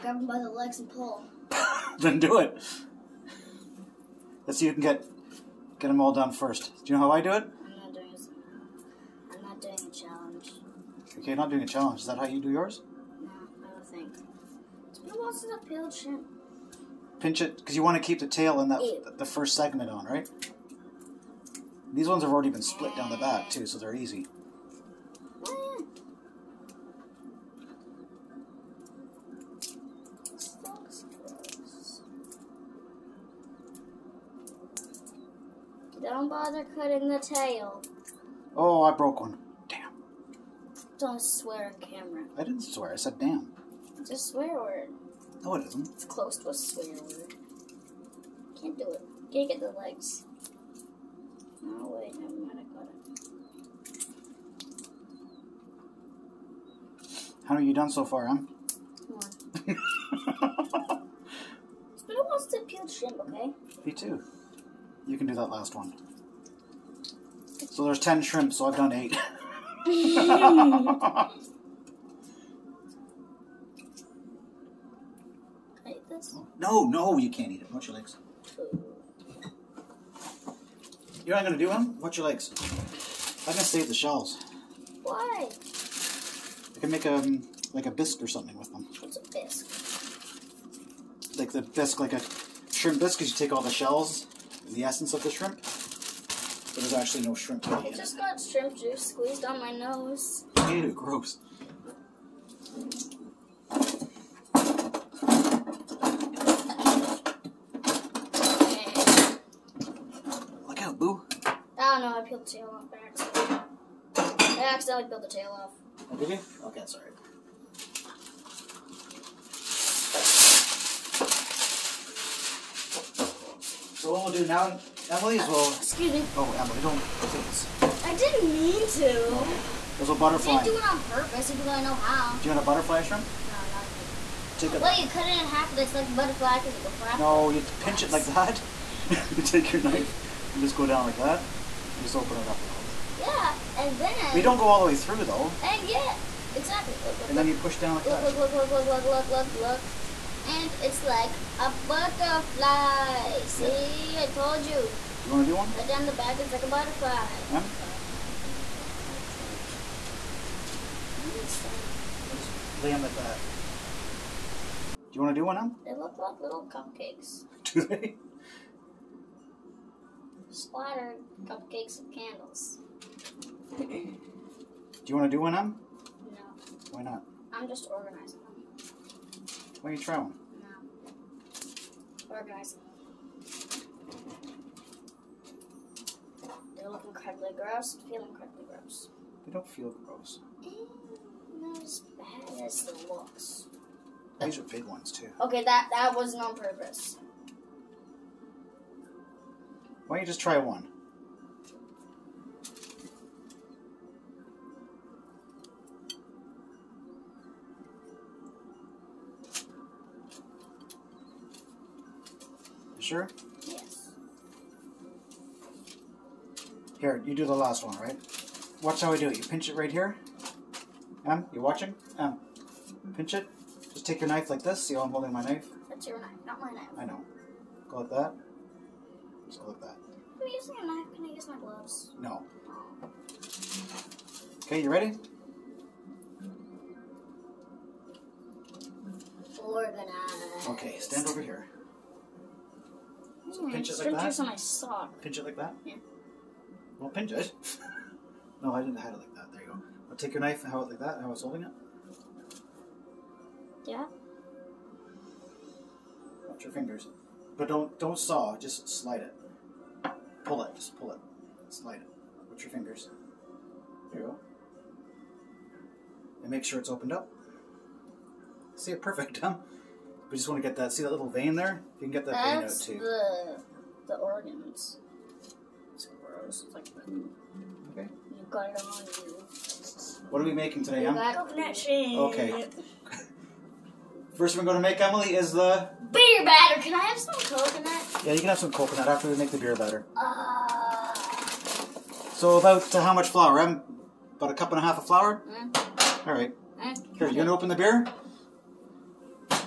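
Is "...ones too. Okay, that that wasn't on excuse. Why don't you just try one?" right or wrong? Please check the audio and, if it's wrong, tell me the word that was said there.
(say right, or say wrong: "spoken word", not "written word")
wrong: "purpose", not "excuse".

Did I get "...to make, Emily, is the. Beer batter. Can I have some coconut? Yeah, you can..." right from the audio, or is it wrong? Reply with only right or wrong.
right.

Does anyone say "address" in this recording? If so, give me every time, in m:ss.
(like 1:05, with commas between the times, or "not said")
not said.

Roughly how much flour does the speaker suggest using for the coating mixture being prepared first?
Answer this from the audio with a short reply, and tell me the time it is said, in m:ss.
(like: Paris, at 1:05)
a cup and a half, at 4:53.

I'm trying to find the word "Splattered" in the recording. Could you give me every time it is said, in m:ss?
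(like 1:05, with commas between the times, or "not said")
2:50.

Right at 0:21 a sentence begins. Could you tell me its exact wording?
These ones have already been split down the back too, so they're easy.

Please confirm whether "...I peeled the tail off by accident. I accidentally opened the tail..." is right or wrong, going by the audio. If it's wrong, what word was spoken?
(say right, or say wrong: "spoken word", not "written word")
wrong: "peeled", not "opened".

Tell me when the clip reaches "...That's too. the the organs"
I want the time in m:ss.
4:32.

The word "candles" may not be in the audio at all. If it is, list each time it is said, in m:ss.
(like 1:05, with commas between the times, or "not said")
2:52.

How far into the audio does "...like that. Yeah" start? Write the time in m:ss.
4:05.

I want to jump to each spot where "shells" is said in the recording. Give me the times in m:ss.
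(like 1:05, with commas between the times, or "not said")
1:23, 1:33.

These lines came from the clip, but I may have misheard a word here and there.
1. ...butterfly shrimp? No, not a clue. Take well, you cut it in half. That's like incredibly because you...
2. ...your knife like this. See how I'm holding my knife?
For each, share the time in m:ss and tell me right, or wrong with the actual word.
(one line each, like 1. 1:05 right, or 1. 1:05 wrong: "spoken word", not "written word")
1. 2:12 wrong: "butterfly", not "incredibly"
2. 3:44 right.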